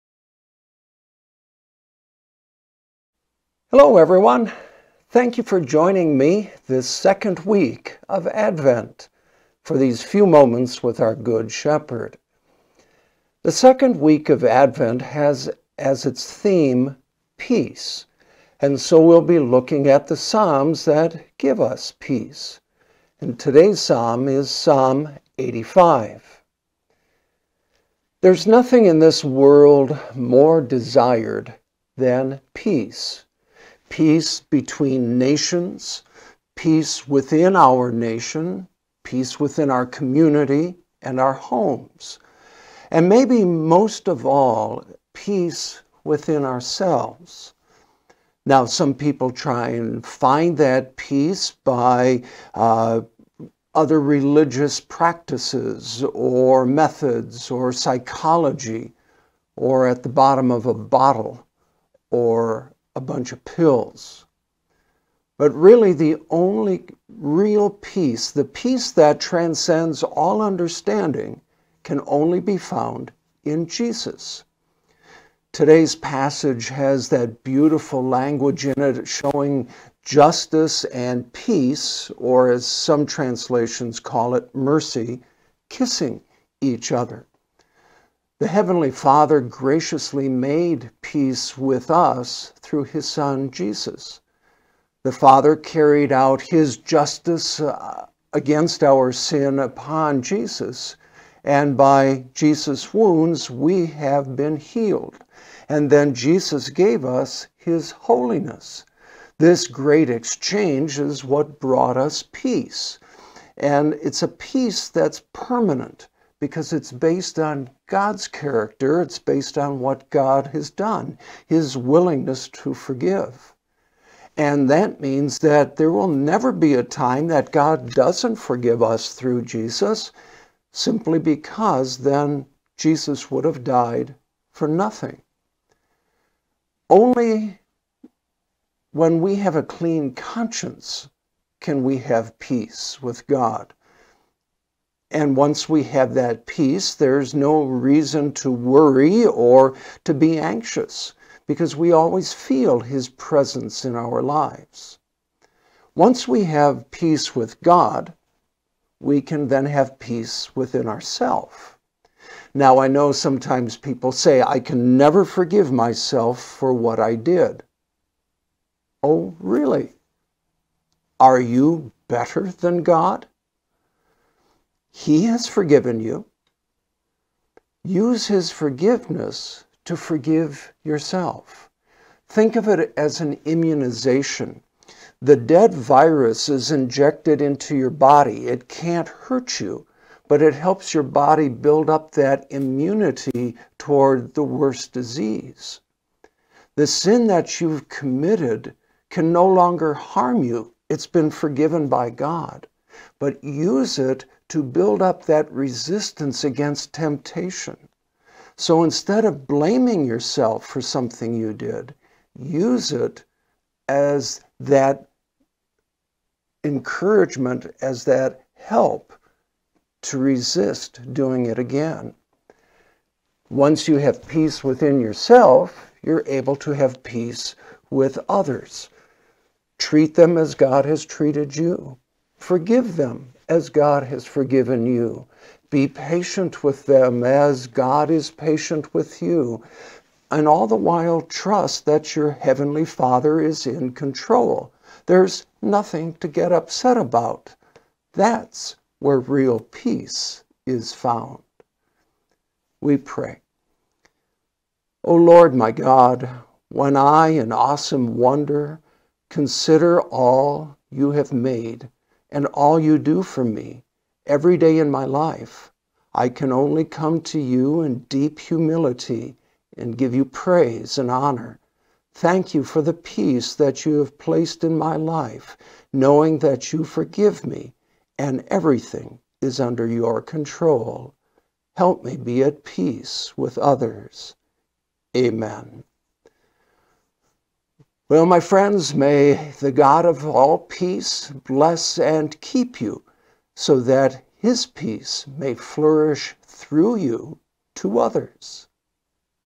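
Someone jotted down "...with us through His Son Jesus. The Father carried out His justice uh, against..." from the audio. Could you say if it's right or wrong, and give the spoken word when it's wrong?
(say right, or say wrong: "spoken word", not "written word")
right.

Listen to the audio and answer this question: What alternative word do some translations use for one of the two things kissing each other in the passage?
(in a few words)
mercy.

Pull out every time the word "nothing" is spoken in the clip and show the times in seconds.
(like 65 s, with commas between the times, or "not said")
28 s, 134 s, 245 s.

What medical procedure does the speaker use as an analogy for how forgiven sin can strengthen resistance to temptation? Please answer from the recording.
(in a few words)
immunization.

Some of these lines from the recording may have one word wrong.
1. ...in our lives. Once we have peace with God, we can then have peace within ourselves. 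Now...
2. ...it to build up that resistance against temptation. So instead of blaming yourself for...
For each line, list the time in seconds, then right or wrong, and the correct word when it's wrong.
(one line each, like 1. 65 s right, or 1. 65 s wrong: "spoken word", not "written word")
1. 153 s right
2. 203 s right.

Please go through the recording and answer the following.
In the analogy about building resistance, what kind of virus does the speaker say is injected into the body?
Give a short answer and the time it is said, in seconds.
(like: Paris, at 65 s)
dead virus, at 185 s.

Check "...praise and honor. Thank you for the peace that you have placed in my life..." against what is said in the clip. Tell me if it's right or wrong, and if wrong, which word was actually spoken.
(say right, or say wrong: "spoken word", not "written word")
right.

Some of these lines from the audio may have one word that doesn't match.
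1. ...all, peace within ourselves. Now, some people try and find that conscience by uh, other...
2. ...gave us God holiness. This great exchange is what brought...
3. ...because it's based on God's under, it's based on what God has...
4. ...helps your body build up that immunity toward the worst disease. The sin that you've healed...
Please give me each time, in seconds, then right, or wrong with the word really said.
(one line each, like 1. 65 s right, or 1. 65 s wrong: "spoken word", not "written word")
1. 44 s wrong: "peace", not "conscience"
2. 106 s wrong: "His", not "God"
3. 116 s wrong: "character", not "under"
4. 190 s wrong: "committed", not "healed".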